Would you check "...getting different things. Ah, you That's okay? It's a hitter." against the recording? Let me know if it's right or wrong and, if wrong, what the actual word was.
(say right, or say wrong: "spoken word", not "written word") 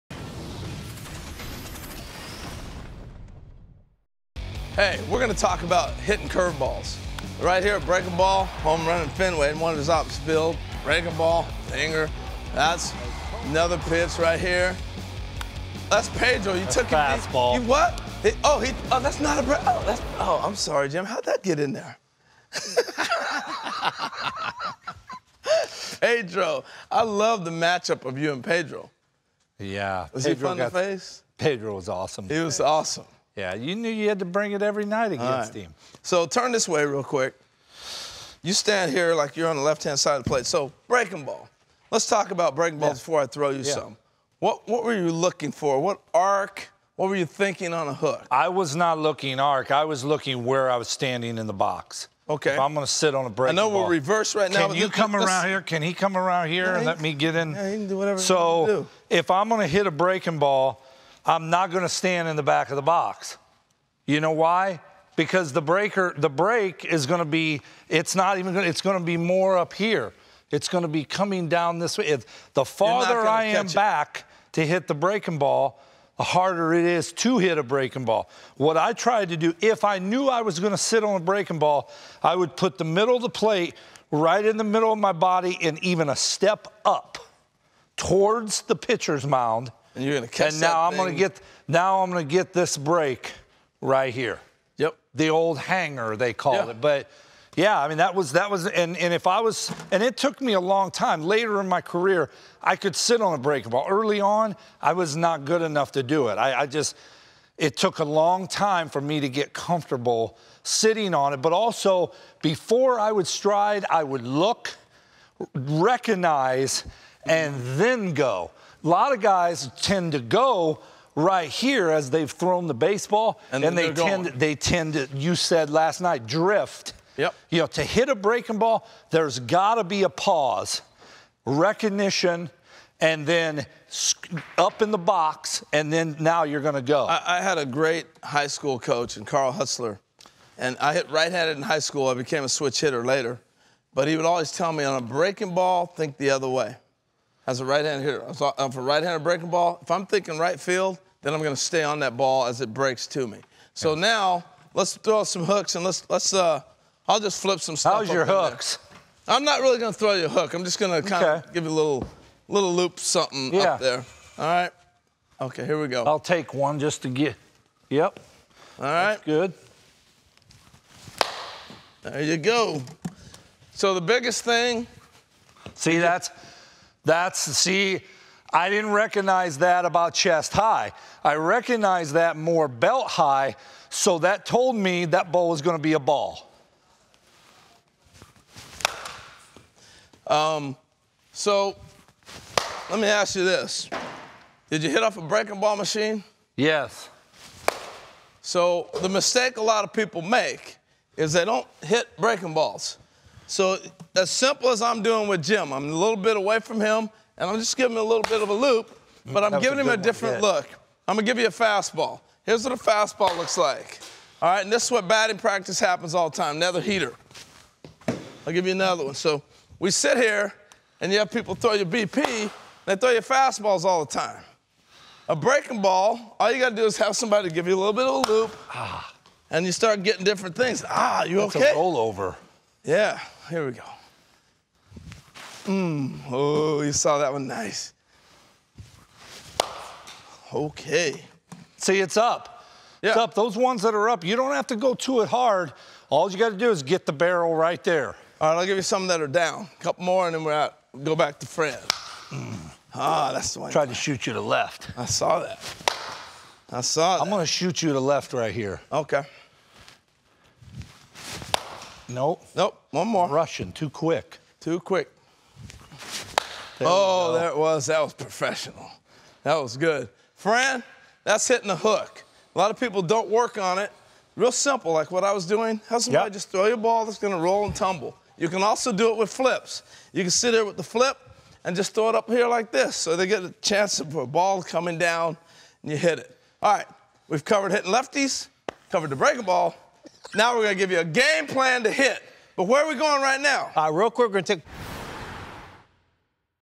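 wrong: "rollover", not "hitter".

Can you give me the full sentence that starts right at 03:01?
I recognized that more belt high, so that told me that ball was going to be a ball.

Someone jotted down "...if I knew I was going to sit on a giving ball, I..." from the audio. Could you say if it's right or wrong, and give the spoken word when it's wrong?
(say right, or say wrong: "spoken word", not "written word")
wrong: "breaking", not "giving".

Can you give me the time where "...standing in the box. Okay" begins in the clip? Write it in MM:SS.
00:50.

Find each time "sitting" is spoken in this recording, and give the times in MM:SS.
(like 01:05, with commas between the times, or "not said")
01:50.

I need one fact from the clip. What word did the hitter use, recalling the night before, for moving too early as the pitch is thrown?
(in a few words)
Drift.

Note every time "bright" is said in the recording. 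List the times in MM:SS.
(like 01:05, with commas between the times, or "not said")
not said.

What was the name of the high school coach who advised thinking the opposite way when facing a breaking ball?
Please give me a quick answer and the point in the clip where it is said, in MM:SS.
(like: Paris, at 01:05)
Carl Hustler, at 02:19.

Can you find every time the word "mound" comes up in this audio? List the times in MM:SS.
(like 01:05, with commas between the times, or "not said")
01:29.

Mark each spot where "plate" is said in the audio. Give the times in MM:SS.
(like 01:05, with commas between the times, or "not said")
00:40, 01:23.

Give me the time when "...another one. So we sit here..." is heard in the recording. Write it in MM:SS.
03:38.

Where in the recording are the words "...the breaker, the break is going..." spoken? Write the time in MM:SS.
01:05.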